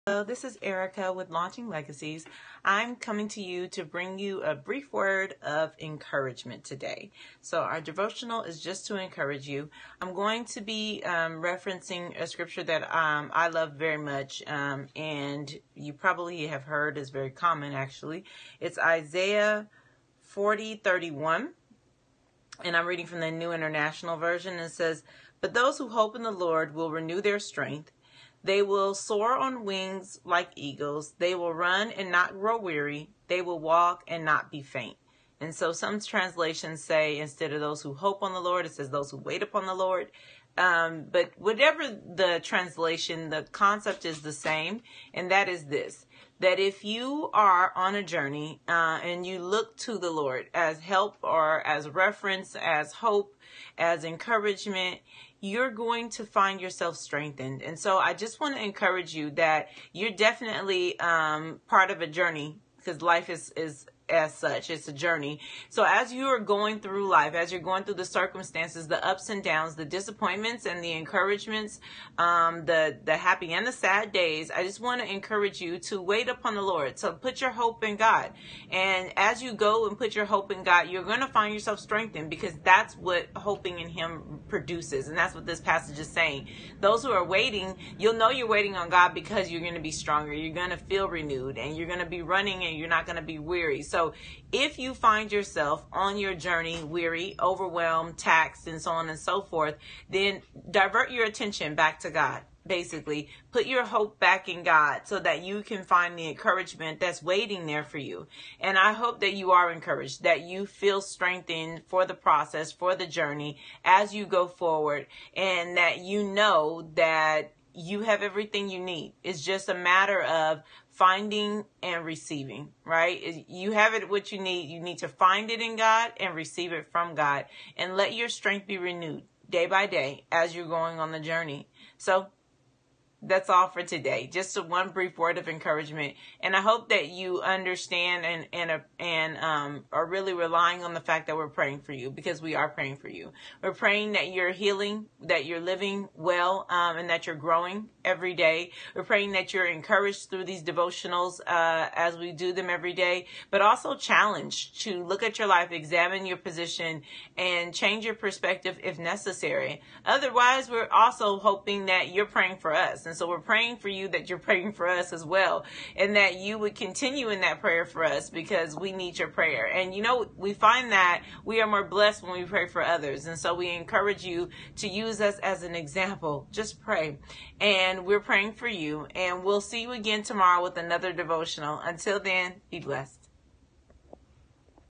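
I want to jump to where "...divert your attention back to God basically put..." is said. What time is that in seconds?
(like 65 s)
100 s.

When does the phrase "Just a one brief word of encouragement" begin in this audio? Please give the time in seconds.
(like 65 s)
134 s.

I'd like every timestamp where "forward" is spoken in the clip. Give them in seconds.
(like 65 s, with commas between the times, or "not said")
114 s.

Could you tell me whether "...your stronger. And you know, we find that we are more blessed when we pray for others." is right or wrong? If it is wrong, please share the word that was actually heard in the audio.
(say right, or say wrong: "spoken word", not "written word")
wrong: "prayer", not "stronger".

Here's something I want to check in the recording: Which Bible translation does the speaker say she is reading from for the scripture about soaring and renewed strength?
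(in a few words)
New International Version.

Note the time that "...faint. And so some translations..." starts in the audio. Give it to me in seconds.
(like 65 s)
34 s.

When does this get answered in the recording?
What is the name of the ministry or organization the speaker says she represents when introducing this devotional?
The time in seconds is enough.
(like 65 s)
1 s.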